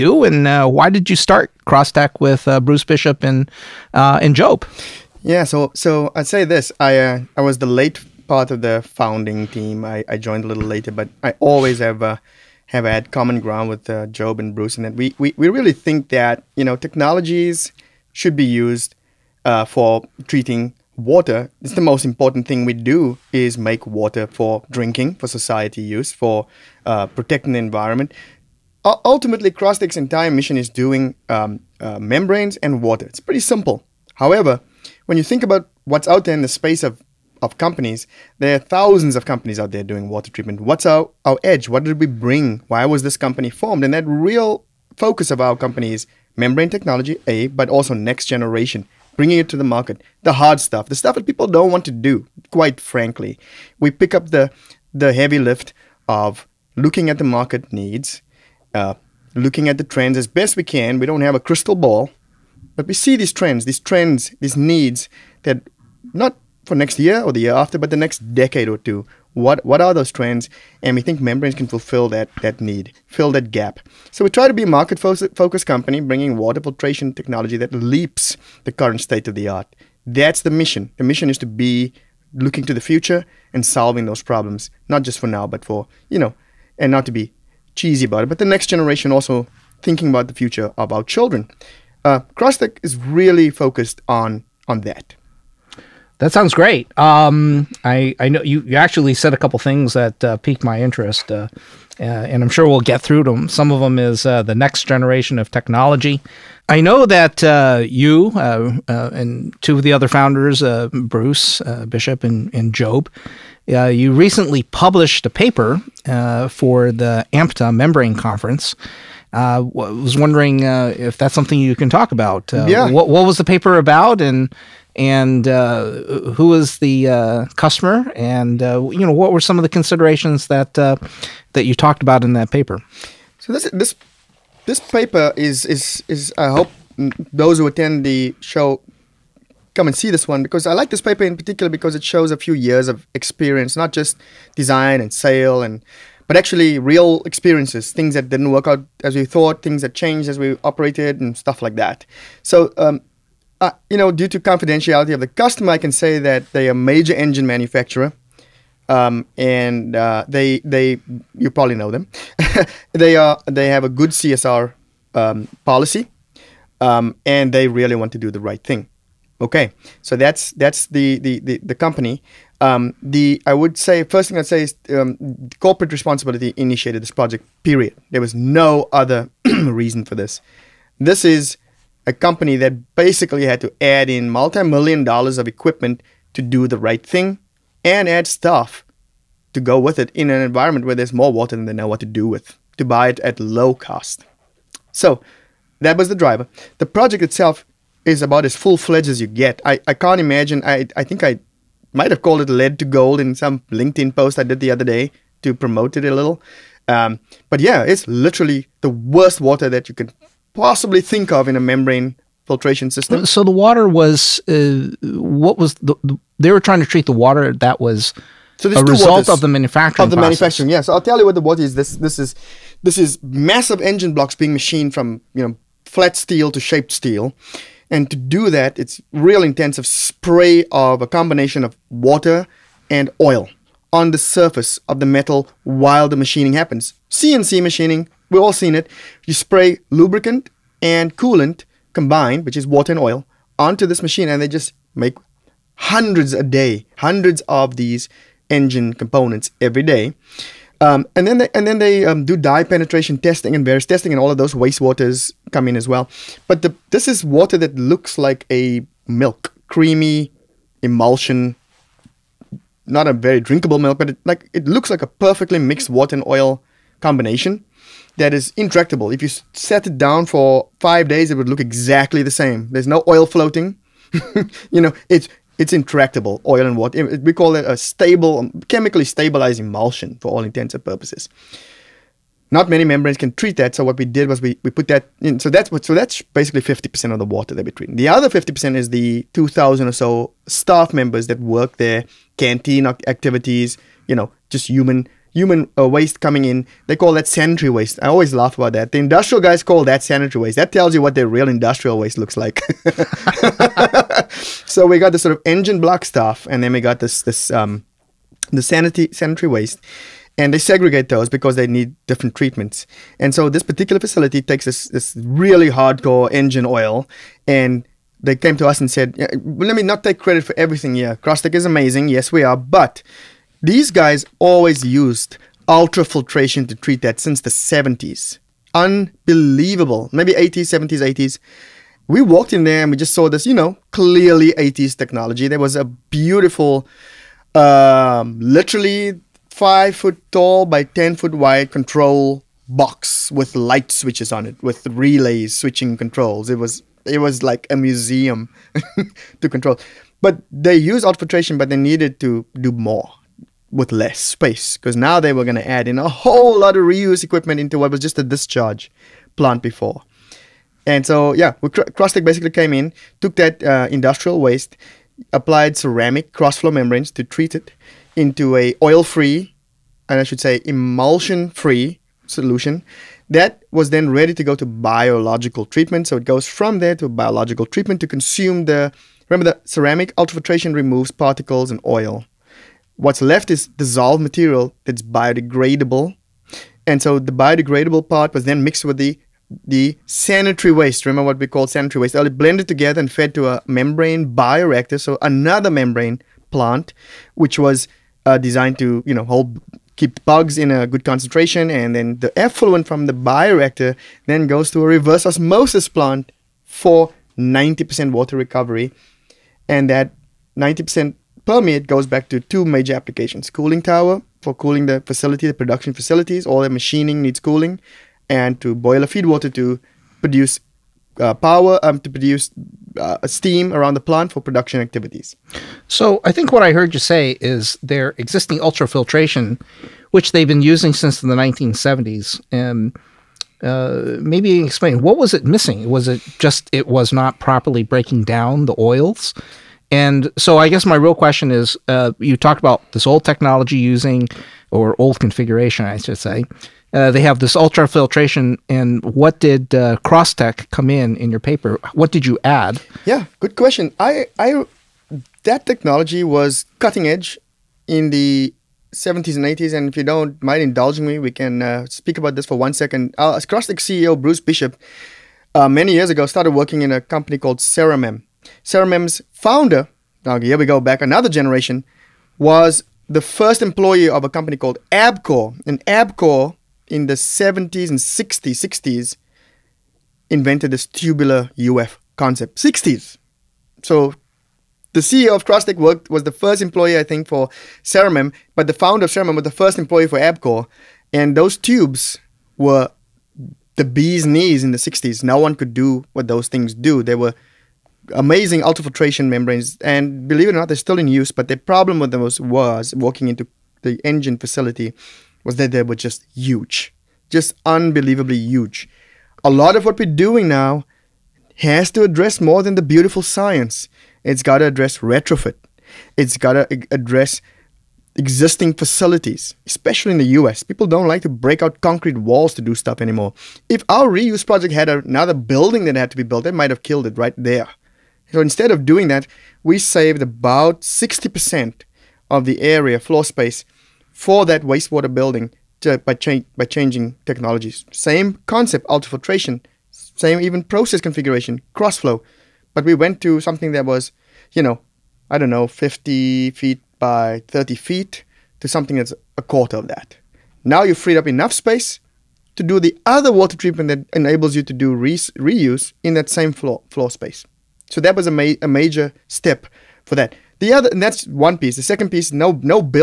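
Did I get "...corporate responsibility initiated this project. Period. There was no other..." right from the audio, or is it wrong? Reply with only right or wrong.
right.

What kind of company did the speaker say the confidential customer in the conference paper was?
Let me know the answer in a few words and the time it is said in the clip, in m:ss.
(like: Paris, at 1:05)
Major engine manufacturer, at 2:36.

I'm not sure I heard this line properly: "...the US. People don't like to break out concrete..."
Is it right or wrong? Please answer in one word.
right.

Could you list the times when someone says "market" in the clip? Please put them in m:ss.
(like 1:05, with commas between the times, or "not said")
0:49, 0:57, 1:14.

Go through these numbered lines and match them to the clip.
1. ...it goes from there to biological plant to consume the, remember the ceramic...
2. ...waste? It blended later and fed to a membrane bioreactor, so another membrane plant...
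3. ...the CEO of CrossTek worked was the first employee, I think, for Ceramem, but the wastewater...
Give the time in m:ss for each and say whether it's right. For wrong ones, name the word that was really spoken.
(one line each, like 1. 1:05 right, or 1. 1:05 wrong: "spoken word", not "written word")
1. 6:16 wrong: "treatment", not "plant"
2. 6:32 wrong: "together", not "later"
3. 8:04 wrong: "founder", not "wastewater".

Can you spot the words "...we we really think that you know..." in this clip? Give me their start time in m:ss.
0:15.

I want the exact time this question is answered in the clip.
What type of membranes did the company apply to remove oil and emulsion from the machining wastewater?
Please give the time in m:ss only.
6:05.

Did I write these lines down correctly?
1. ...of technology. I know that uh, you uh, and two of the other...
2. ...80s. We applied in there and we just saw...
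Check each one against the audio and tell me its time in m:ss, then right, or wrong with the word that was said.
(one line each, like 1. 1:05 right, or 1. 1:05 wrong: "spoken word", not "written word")
1. 1:45 right
2. 5:31 wrong: "walked", not "applied".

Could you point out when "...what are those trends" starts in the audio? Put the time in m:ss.
1:09.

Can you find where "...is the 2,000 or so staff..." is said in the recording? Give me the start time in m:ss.
4:48.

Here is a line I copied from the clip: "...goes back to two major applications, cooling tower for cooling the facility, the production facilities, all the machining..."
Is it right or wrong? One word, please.
right.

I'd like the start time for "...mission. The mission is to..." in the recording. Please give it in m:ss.
1:20.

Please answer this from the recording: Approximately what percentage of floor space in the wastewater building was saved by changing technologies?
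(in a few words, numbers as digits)
60%.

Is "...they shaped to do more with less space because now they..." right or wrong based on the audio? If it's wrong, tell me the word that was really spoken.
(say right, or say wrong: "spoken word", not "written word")
wrong: "needed", not "shaped".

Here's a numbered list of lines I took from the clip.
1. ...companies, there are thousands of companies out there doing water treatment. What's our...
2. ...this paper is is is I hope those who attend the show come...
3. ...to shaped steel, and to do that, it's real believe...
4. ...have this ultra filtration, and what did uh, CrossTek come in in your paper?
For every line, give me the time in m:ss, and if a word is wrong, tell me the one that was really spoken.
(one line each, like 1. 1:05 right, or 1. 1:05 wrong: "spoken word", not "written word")
1. 0:37 right
2. 2:14 right
3. 3:46 wrong: "intensive", not "believe"
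4. 7:27 right.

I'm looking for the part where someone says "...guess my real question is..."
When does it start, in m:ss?
7:20.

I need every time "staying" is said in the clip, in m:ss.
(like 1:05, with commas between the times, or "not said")
not said.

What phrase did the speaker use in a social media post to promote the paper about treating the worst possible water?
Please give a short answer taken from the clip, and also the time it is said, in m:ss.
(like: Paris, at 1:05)
Lead to gold, at 3:22.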